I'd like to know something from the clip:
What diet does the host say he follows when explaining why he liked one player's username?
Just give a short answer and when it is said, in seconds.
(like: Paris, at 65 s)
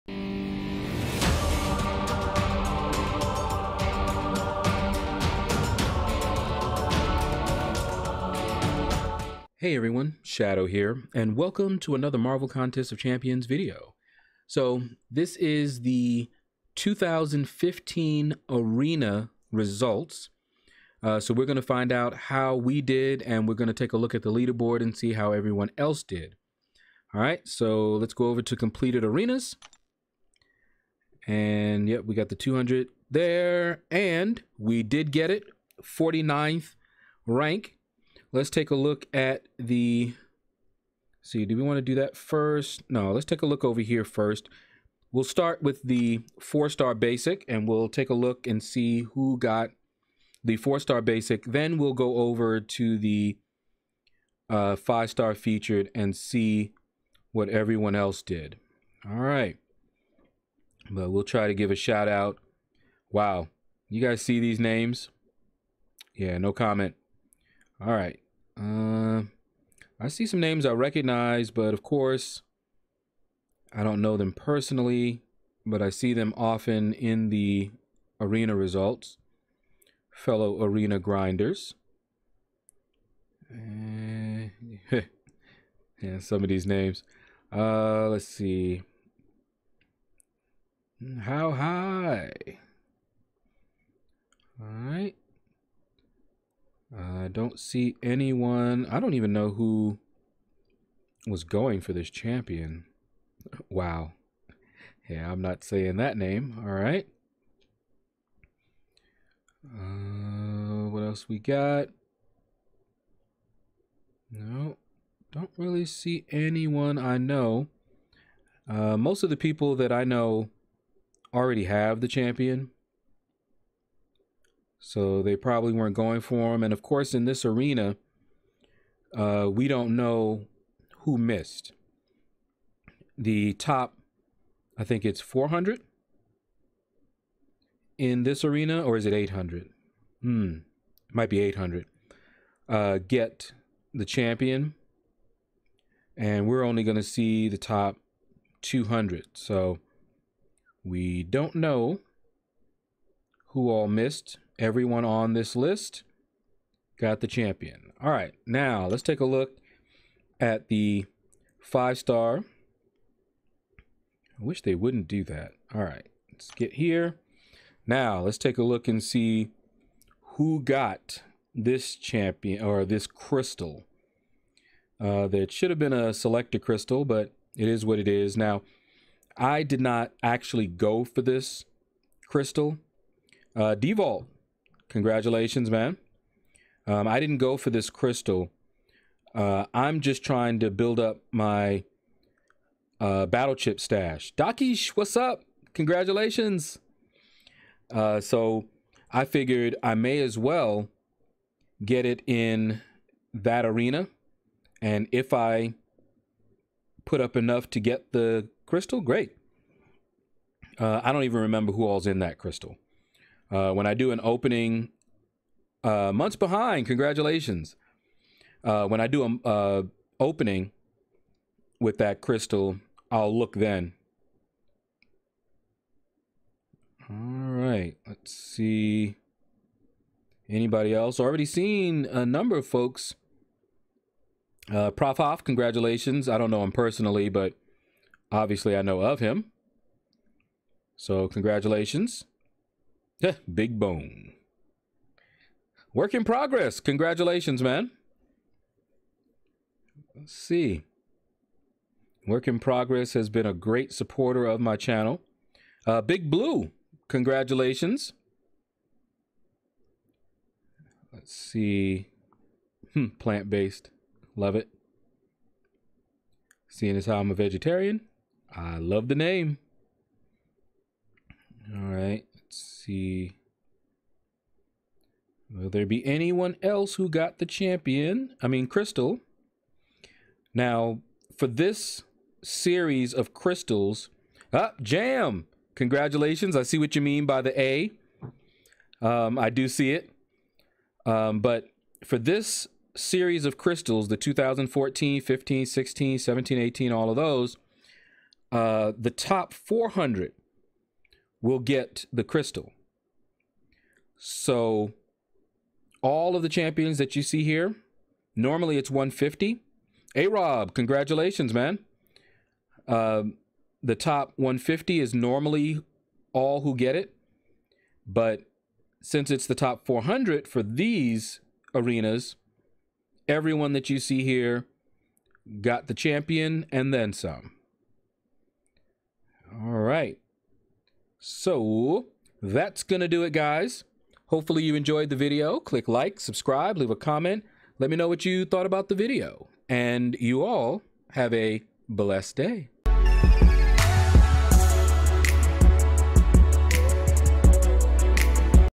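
vegetarian, at 267 s.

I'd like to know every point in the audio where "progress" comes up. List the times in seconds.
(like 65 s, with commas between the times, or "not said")
246 s, 252 s.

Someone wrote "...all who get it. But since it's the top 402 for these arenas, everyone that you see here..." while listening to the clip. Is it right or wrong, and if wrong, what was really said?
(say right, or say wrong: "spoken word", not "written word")
wrong: "400", not "402".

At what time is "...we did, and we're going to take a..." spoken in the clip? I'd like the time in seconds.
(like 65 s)
22 s.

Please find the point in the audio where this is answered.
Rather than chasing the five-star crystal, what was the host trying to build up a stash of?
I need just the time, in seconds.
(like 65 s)
193 s.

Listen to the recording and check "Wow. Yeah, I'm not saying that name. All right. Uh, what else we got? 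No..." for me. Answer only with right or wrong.
right.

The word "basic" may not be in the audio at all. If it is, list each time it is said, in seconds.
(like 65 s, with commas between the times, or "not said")
46 s, 51 s.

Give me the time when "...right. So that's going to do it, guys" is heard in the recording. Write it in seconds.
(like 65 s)
329 s.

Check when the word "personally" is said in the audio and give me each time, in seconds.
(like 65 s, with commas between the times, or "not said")
74 s, 236 s.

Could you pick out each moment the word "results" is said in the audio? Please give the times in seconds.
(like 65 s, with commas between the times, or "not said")
19 s, 78 s.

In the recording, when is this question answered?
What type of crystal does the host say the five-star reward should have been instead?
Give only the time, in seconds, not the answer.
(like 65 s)
176 s.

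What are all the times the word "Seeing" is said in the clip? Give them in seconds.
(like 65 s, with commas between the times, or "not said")
266 s.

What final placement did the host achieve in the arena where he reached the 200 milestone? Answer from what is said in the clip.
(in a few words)
49th.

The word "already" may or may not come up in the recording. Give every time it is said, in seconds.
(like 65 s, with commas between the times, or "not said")
121 s, 231 s.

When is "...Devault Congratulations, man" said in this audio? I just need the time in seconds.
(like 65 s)
183 s.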